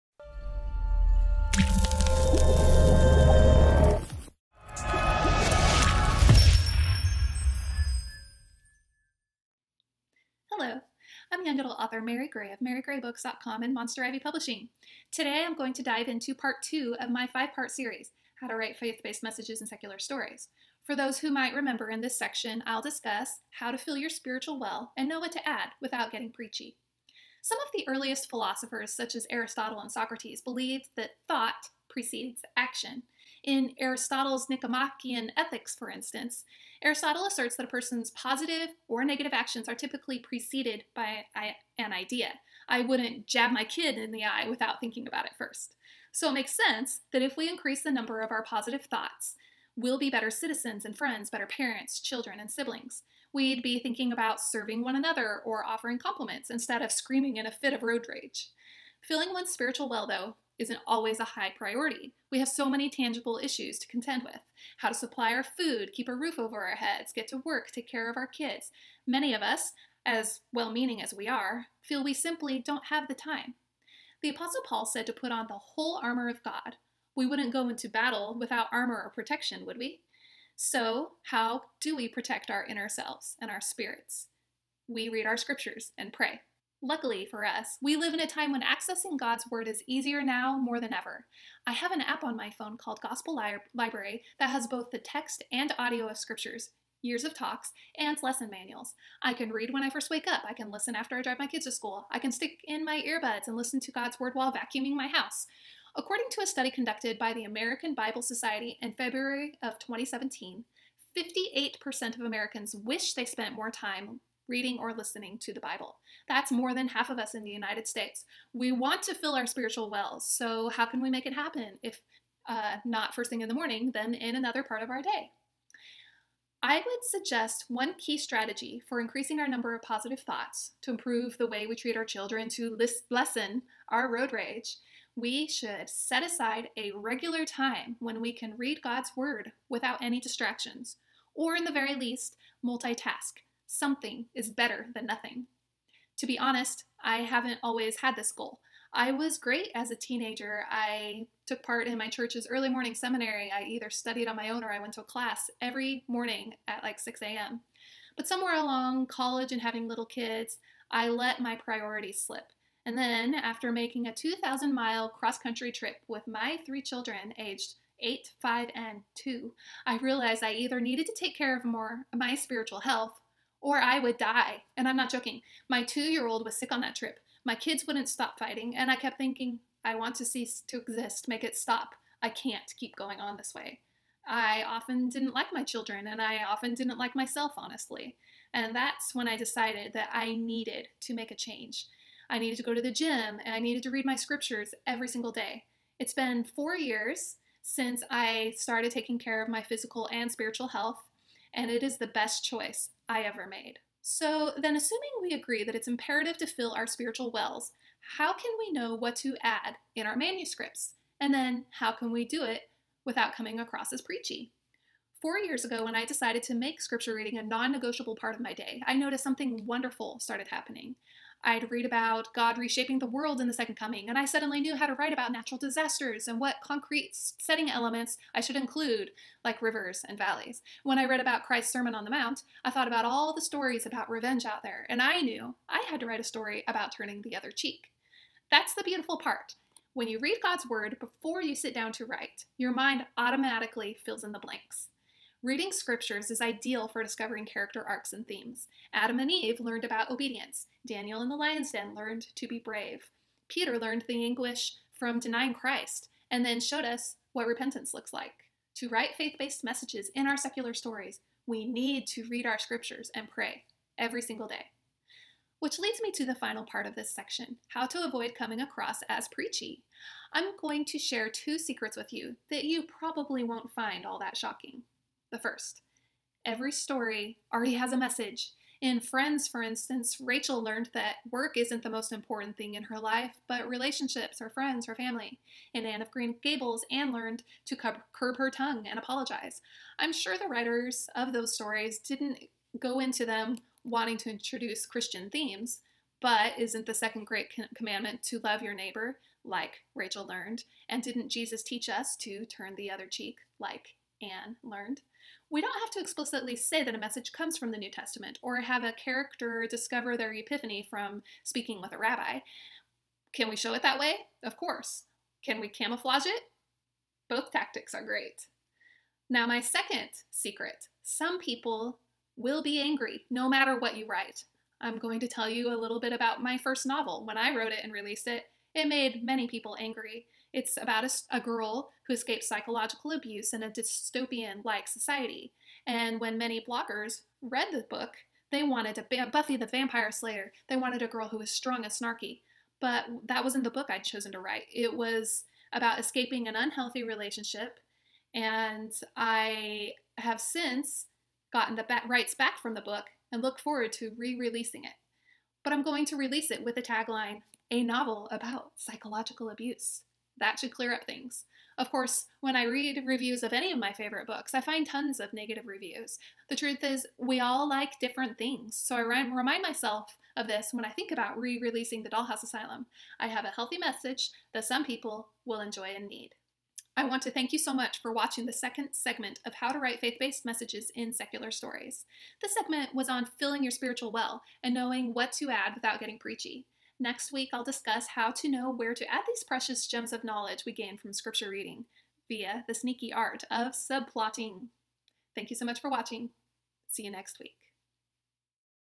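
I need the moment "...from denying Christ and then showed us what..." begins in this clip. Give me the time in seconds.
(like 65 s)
254 s.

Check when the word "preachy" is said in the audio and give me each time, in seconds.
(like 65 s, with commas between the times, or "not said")
26 s, 214 s, 269 s, 386 s.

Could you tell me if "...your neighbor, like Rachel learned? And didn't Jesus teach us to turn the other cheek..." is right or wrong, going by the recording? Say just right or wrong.
right.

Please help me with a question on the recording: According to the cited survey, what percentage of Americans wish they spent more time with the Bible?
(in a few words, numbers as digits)
58%.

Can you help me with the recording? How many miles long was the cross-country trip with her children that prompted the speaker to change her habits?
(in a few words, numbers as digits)
2,000.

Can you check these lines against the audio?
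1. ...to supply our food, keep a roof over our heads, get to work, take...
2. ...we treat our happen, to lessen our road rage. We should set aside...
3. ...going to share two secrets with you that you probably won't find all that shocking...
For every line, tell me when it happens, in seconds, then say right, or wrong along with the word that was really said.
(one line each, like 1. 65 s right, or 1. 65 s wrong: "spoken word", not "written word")
1. 64 s right
2. 131 s wrong: "children", not "happen"
3. 270 s right.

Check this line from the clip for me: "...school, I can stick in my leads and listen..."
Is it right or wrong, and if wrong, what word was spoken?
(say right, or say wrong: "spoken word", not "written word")
wrong: "earbuds", not "leads".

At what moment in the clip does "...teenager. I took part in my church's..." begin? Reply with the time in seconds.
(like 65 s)
149 s.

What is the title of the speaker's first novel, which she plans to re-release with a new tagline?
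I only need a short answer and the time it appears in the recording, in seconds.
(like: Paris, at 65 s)
The Dollhouse Asylum, at 372 s.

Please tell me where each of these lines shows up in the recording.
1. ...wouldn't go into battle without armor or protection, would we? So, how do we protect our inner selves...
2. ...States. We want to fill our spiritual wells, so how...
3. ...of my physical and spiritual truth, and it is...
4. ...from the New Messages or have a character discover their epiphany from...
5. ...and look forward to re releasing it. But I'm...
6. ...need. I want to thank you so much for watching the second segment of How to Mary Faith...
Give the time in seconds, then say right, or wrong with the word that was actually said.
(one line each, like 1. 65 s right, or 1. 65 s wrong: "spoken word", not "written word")
1. 77 s right
2. 117 s right
3. 199 s wrong: "health", not "truth"
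4. 307 s wrong: "Testament", not "Messages"
5. 353 s right
6. 376 s wrong: "Write", not "Mary".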